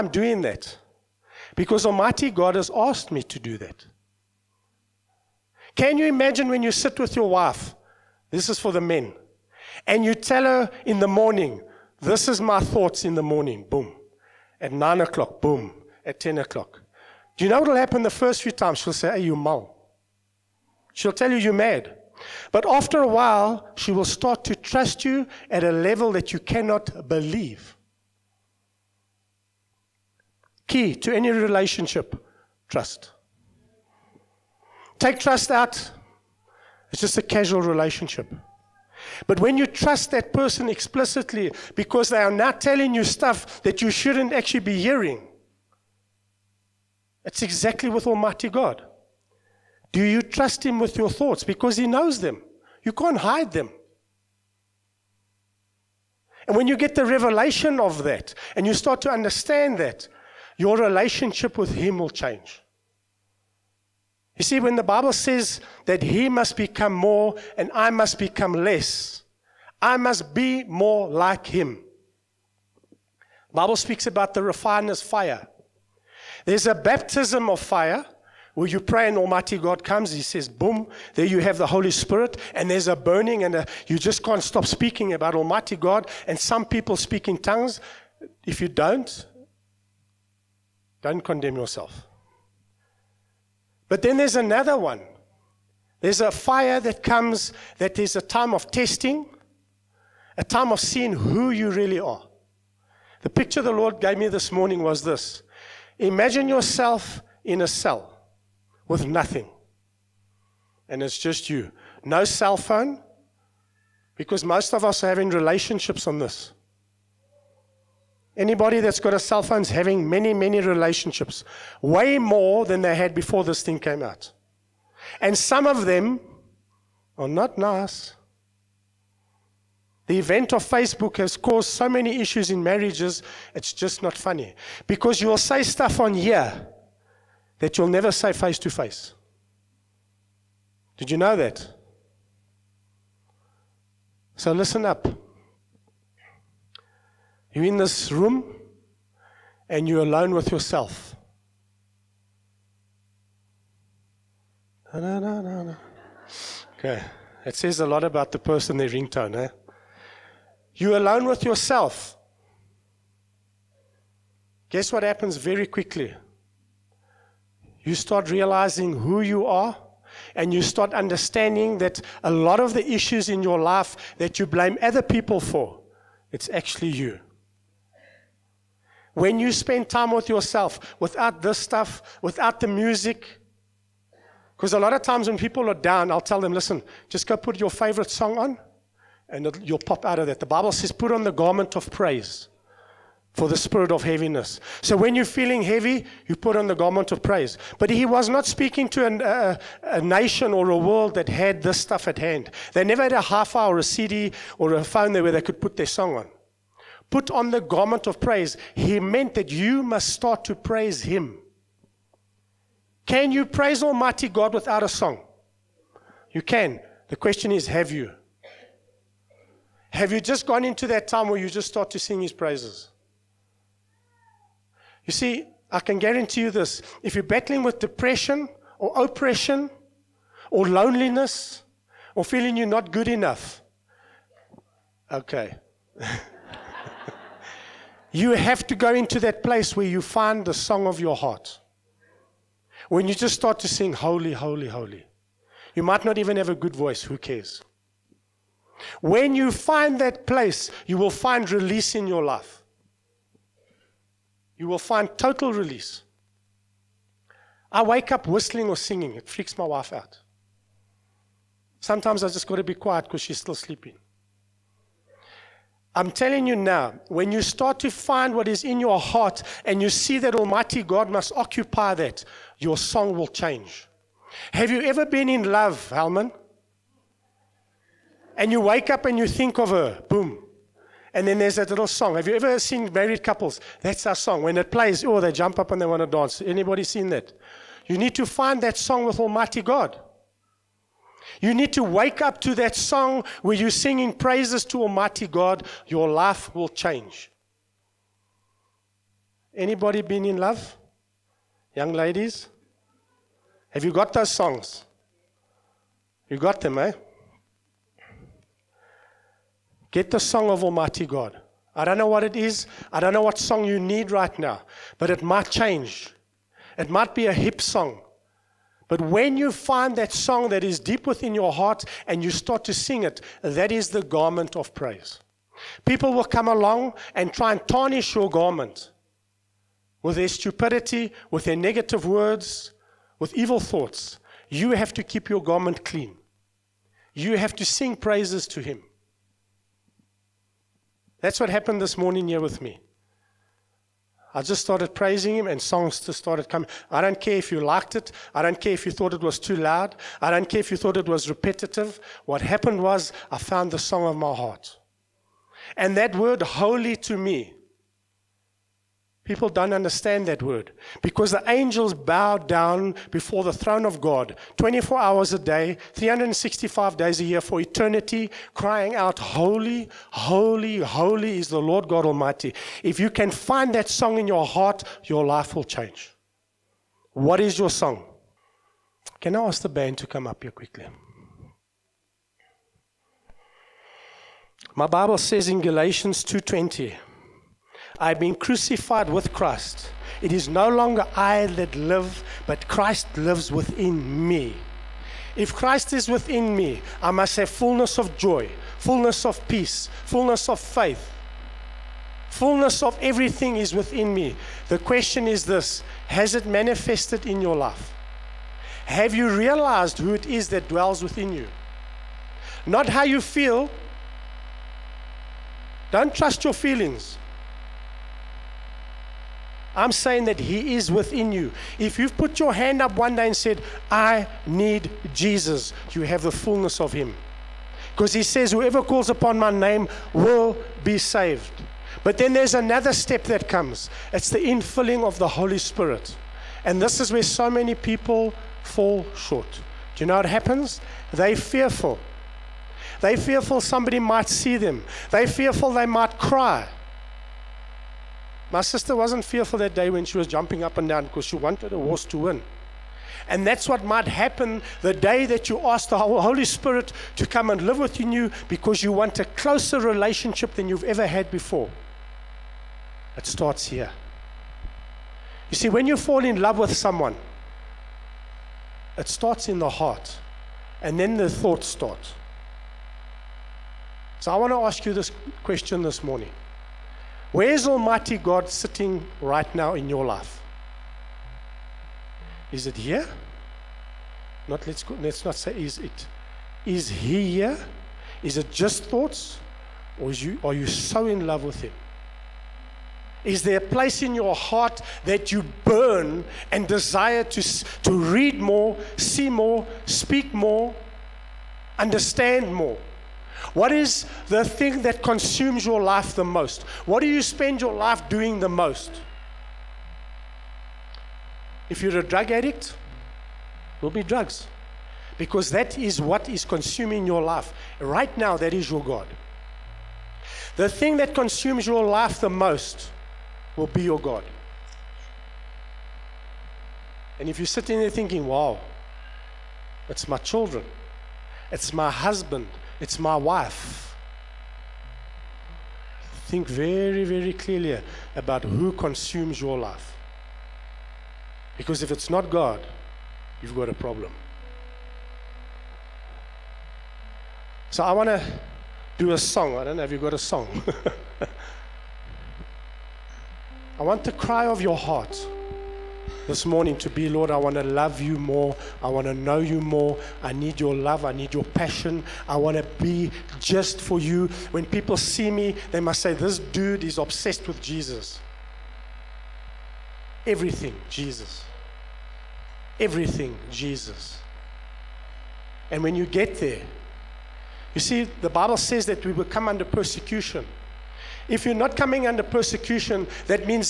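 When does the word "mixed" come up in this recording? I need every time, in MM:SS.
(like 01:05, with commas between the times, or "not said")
not said.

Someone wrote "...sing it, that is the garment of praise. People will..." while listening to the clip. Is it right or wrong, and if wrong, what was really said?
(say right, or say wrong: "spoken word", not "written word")
right.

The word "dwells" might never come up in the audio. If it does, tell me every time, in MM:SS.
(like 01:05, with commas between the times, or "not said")
06:50.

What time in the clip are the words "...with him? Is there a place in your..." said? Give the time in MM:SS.
08:11.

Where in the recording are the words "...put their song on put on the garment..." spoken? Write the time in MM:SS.
03:25.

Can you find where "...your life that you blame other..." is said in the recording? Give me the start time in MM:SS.
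02:53.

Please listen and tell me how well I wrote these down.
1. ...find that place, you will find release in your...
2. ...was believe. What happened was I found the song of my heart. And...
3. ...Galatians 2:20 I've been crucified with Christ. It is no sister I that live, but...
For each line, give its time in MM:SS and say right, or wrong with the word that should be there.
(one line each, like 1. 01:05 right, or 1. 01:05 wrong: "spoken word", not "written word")
1. 04:09 right
2. 05:51 wrong: "repetitive", not "believe"
3. 06:25 wrong: "longer", not "sister".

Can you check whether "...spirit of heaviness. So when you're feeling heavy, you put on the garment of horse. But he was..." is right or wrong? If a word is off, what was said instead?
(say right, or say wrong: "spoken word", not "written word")
wrong: "praise", not "horse".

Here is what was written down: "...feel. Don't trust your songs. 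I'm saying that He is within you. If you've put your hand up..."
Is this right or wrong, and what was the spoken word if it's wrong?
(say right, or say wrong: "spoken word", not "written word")
wrong: "feelings", not "songs".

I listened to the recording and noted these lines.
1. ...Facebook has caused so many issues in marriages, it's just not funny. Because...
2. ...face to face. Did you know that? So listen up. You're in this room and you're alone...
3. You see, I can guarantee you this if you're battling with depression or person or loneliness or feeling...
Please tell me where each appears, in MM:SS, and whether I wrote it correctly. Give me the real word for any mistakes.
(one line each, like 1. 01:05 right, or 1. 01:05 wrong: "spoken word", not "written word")
1. 02:10 right
2. 02:18 right
3. 03:45 wrong: "oppression", not "person".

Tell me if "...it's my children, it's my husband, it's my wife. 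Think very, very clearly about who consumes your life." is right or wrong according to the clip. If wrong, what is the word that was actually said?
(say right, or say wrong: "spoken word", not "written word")
right.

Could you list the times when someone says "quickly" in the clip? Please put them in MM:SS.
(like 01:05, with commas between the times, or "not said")
02:45, 06:20.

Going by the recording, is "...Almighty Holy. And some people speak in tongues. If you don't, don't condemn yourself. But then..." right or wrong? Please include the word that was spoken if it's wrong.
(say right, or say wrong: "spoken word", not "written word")
wrong: "God", not "Holy".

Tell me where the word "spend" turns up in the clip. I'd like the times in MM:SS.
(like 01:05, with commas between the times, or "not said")
02:59, 08:27.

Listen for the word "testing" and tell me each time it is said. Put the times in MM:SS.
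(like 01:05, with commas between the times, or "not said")
01:38.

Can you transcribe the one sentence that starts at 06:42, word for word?
Fullness of everything is within me.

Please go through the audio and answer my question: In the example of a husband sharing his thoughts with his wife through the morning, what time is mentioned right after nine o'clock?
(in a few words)
10 o'clock.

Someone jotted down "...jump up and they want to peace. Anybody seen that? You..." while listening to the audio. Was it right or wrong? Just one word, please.
wrong.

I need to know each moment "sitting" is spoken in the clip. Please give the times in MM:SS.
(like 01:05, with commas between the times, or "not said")
07:58, 08:47.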